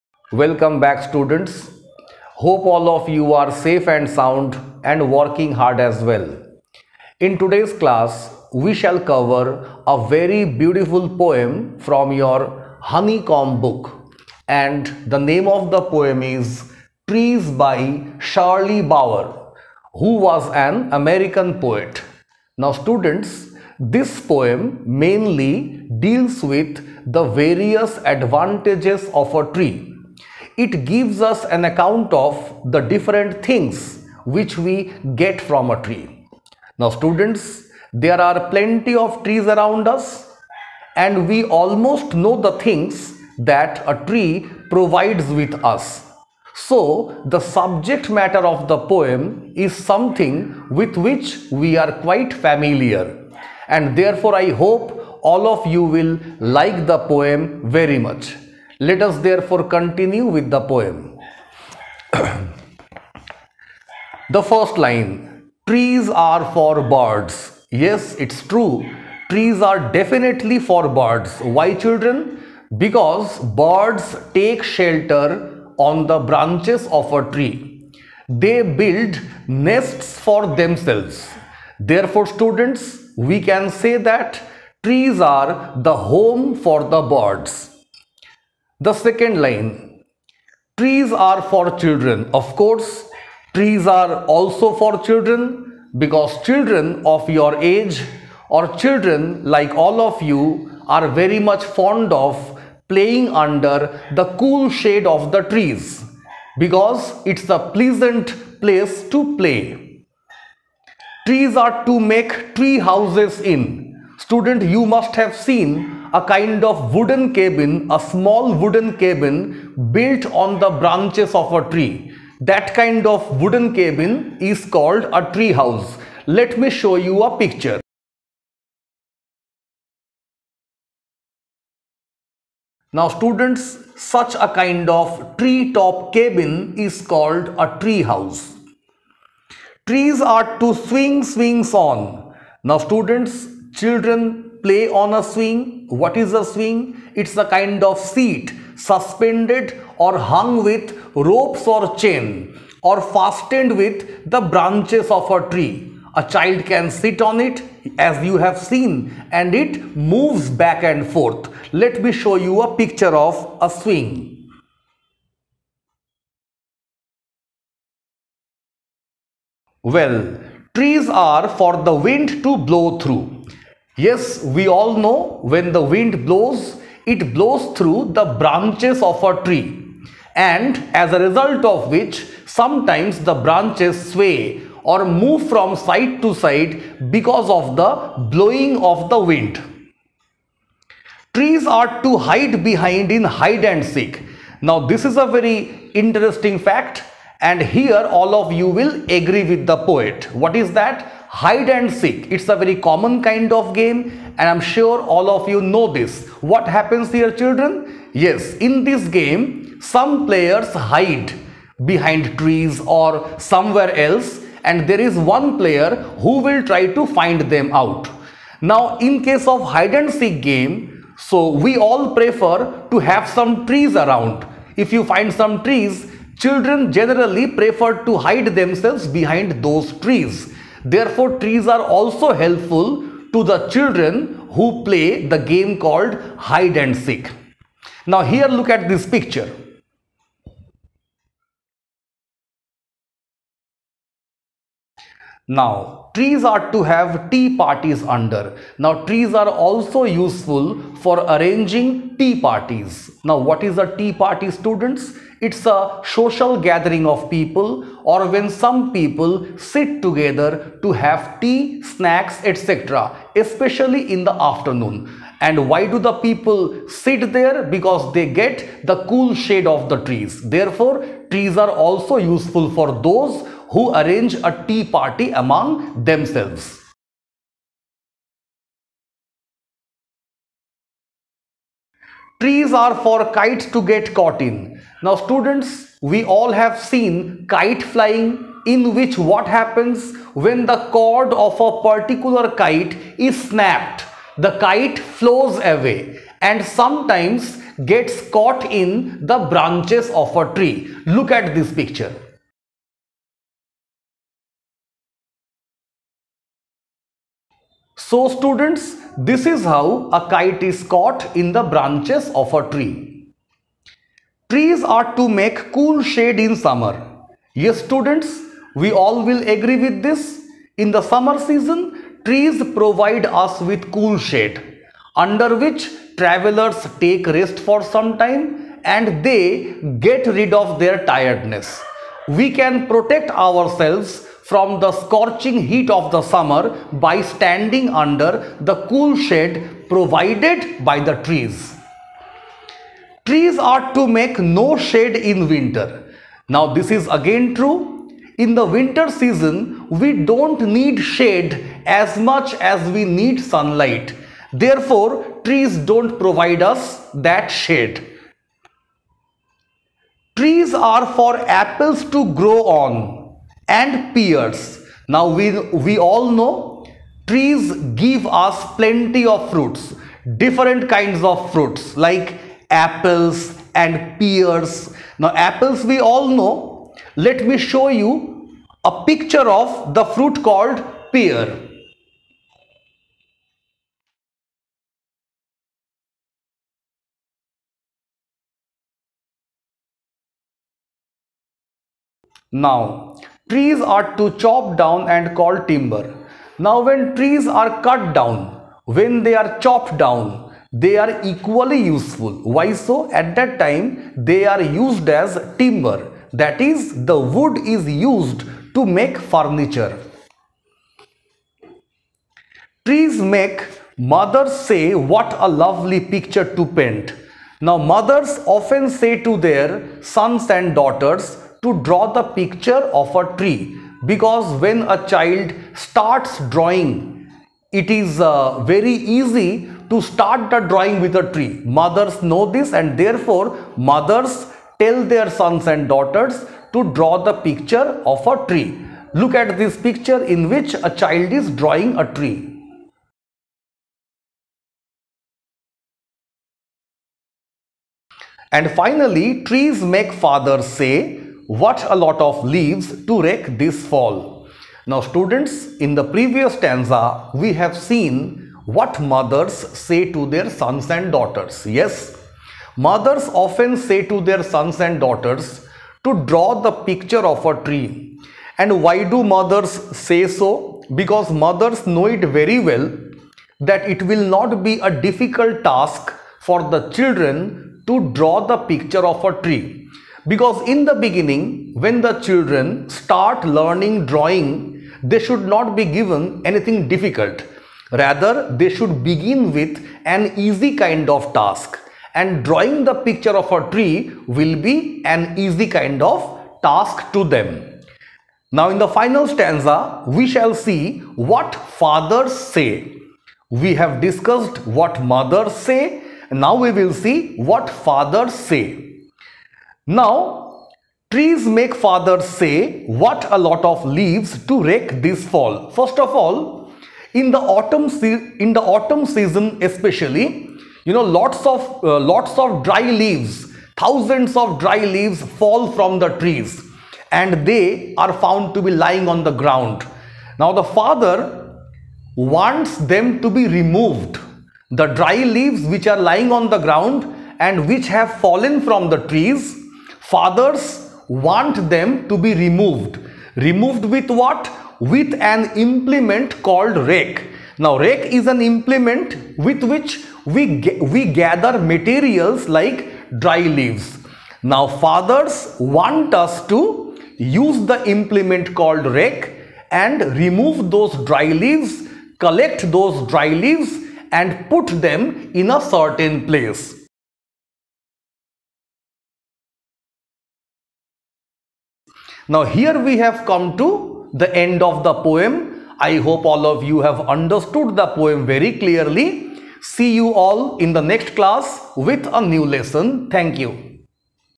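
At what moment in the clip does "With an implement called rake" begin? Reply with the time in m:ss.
9:04.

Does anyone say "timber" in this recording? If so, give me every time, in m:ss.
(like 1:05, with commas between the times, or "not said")
6:35, 6:45.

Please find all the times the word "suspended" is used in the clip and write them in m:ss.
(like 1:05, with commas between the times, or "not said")
2:28.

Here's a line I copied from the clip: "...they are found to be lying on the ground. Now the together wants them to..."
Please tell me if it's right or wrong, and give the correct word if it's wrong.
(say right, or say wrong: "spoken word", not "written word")
wrong: "father", not "together".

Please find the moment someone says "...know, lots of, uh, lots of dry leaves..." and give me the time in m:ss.
8:40.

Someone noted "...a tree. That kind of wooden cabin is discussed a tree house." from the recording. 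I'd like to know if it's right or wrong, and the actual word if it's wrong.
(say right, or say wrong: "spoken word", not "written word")
wrong: "called", not "discussed".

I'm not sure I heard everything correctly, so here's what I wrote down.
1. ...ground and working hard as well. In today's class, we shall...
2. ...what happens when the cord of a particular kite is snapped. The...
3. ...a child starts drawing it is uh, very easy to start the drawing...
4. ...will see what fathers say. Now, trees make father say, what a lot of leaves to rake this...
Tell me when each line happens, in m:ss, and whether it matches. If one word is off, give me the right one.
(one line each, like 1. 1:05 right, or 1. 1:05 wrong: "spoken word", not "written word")
1. 0:04 wrong: "sound", not "ground"
2. 4:49 right
3. 7:04 right
4. 8:26 right.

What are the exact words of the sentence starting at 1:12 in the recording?
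Because birds take shelter on the branches of a tree.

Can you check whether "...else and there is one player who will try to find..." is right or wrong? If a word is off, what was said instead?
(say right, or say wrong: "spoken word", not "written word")
right.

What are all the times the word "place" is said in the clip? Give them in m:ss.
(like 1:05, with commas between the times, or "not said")
1:48, 9:26.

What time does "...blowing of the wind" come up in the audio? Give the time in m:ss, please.
3:08.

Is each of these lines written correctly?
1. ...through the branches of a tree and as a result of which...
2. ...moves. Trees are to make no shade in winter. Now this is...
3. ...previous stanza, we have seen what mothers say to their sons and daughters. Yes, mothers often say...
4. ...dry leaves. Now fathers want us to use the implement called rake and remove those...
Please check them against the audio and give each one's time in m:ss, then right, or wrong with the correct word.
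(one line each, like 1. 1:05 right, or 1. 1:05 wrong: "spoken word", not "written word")
1. 2:57 right
2. 5:41 wrong: "trees", not "moves"
3. 7:36 right
4. 9:13 right.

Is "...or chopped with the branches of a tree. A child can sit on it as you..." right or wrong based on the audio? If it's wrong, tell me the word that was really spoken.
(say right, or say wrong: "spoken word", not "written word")
wrong: "fastened", not "chopped".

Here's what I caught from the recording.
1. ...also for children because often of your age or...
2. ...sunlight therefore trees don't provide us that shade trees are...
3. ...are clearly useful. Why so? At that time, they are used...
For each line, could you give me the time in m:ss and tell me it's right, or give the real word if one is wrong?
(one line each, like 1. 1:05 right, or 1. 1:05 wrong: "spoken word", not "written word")
1. 1:34 wrong: "children", not "often"
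2. 5:53 right
3. 6:40 wrong: "equally", not "clearly".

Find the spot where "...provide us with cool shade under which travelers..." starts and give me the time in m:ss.
5:22.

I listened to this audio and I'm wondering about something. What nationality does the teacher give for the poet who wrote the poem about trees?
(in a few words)
American.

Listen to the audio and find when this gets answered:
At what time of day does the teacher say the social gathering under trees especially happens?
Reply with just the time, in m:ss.
4:24.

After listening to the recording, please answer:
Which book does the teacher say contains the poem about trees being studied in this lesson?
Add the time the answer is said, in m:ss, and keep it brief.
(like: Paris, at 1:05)
Honeycomb, at 0:12.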